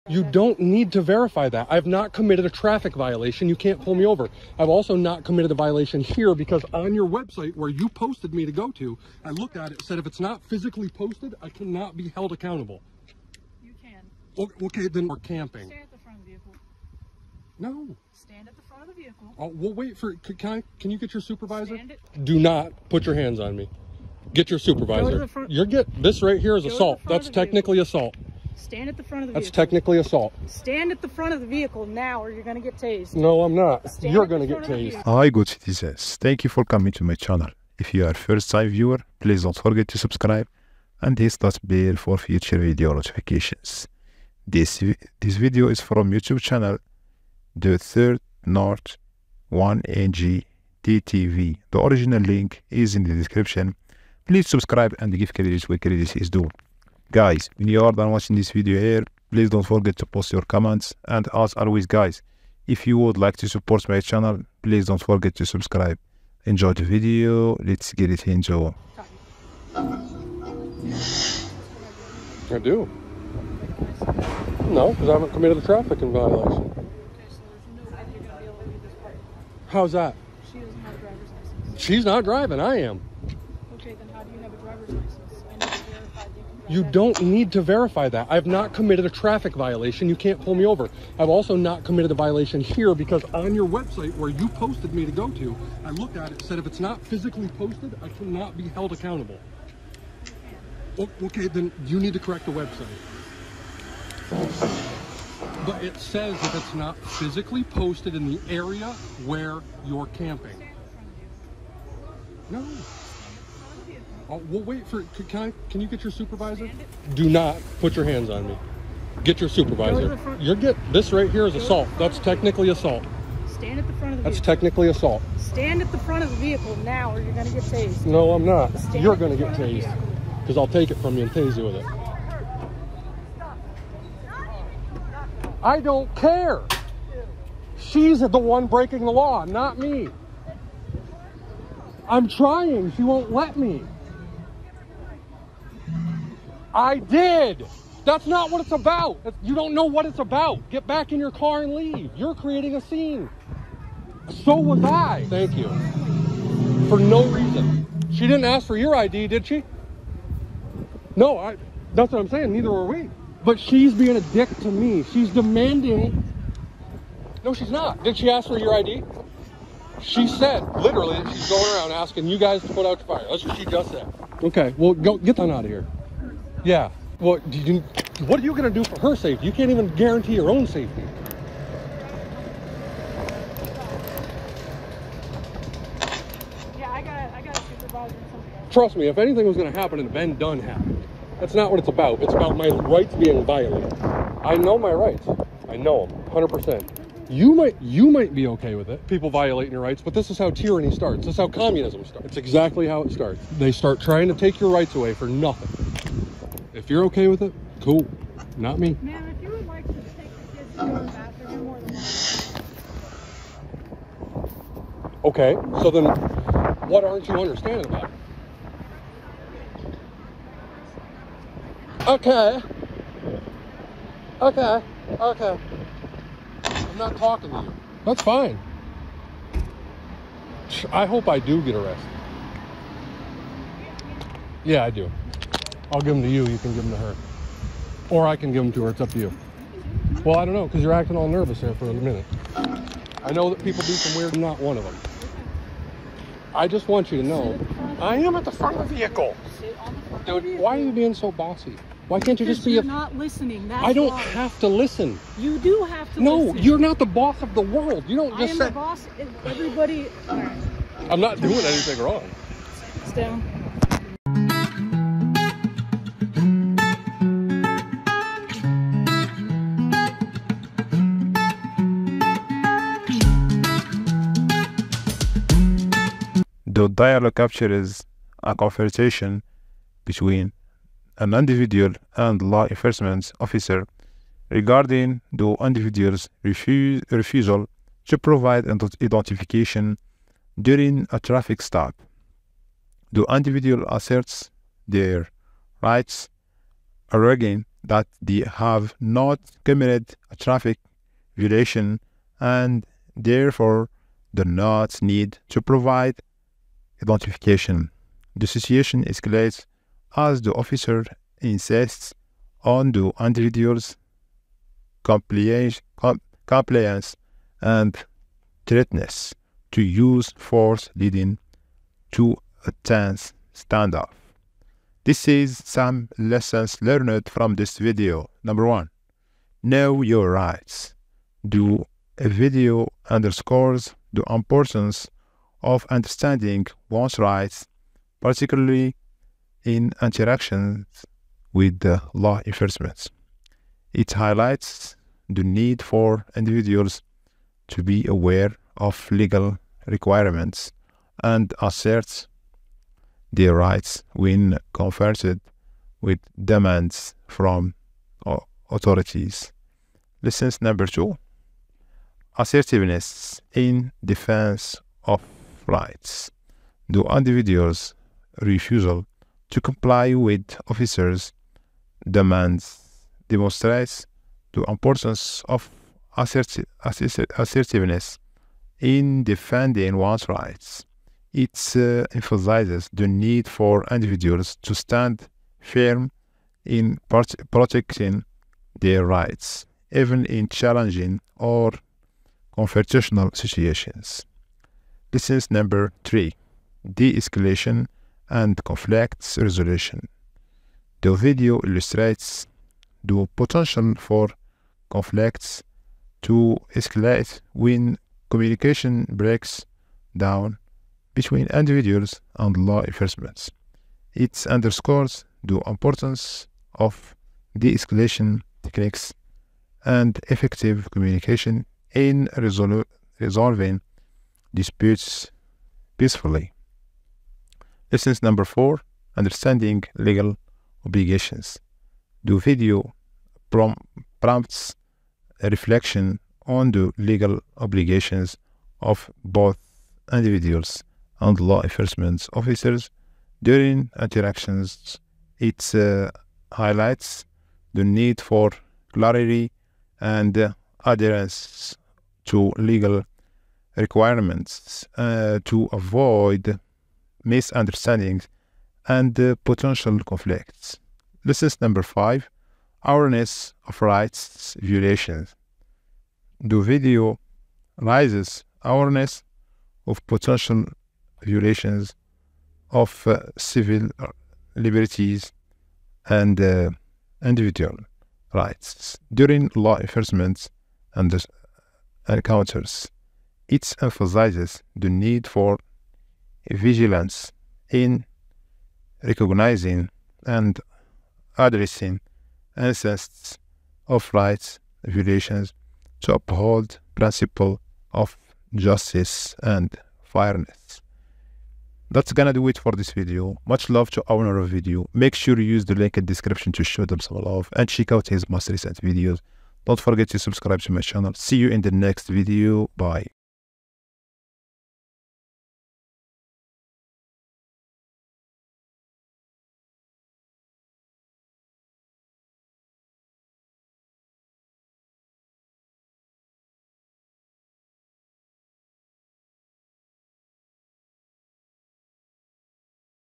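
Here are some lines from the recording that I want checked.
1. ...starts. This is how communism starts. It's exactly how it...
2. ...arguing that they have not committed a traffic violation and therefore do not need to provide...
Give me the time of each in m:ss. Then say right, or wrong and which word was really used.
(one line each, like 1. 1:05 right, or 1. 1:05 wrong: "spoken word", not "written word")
1. 3:20 right
2. 4:57 right.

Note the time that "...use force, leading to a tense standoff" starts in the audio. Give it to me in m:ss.
5:19.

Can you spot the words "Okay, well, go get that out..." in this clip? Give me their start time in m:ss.
2:54.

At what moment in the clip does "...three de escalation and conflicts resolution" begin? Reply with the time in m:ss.
6:36.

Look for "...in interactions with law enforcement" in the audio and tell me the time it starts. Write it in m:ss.
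5:39.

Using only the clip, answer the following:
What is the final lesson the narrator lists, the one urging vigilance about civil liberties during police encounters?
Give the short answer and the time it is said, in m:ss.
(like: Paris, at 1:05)
Awareness of rights violations, at 7:42.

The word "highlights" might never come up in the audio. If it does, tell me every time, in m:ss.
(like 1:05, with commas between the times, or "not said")
5:44, 7:26.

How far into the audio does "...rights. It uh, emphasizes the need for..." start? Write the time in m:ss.
6:20.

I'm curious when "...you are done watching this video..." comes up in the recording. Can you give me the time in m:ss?
0:57.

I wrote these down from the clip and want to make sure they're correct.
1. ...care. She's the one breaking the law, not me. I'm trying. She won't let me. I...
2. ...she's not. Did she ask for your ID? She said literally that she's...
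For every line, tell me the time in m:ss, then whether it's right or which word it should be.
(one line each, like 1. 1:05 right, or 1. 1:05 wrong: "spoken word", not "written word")
1. 2:16 right
2. 2:47 right.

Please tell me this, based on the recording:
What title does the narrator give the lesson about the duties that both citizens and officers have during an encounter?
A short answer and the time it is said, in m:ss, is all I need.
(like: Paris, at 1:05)
Understanding legal obligations, at 7:09.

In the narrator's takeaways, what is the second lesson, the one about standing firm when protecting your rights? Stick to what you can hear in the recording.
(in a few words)
Assertiveness in defense of rights.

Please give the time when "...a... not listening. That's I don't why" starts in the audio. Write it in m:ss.
4:12.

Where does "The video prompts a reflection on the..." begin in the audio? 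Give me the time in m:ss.
7:12.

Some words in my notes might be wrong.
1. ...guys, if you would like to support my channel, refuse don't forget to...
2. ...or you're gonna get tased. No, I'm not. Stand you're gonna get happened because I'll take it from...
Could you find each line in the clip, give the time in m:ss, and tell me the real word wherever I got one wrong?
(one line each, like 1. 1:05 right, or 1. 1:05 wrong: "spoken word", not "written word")
1. 1:01 wrong: "please", not "refuse"
2. 2:07 wrong: "tased", not "happened".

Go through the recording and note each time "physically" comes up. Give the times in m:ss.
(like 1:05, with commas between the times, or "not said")
0:10, 1:37, 1:46.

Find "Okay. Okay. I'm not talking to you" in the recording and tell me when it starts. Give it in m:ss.
3:44.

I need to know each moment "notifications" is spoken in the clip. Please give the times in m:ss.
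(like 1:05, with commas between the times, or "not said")
0:42.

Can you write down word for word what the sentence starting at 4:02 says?
I know that people do some weird, not one of them.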